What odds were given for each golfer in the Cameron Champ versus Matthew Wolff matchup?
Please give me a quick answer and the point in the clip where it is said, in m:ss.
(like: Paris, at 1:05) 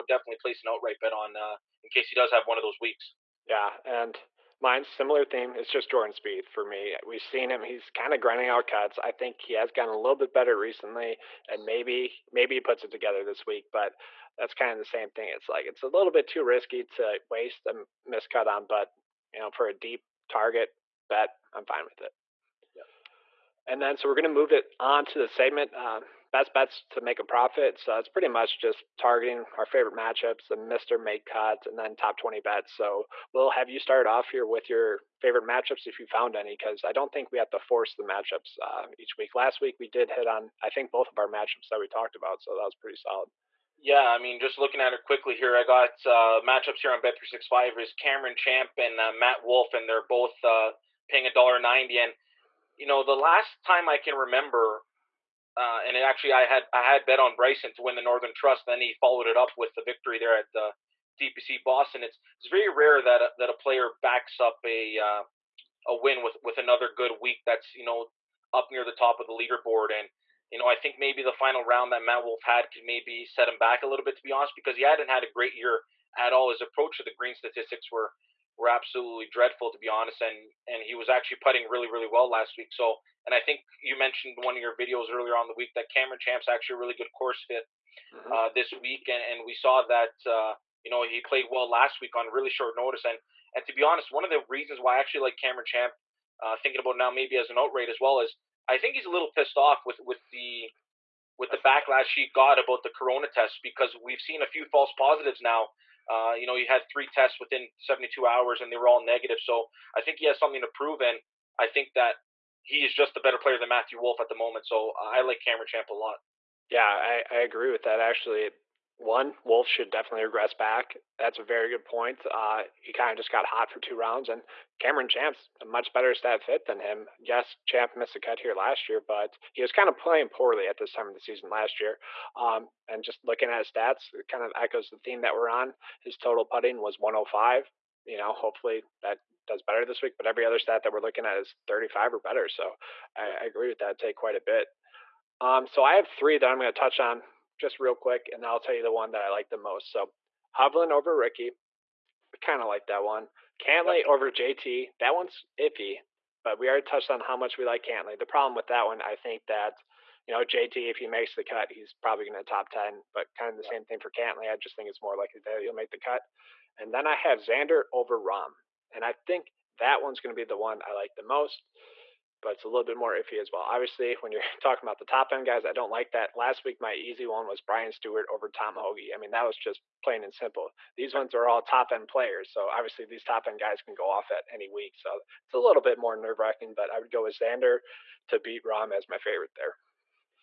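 1.90, at 0:51.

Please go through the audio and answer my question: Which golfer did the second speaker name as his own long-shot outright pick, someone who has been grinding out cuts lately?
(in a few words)
Jordan Spieth.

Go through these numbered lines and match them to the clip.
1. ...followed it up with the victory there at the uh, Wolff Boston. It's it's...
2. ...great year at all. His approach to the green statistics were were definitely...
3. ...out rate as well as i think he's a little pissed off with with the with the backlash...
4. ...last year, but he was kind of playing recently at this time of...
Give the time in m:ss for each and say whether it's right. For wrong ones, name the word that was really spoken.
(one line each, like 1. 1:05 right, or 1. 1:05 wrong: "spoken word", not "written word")
1. 0:59 wrong: "TPC", not "Wolff"
2. 1:15 wrong: "absolutely", not "definitely"
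3. 1:37 right
4. 2:08 wrong: "poorly", not "recently".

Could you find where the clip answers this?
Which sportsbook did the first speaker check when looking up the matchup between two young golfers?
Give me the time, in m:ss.
0:47.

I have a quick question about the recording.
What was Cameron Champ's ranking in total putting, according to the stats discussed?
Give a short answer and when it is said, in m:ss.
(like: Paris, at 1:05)
105, at 2:16.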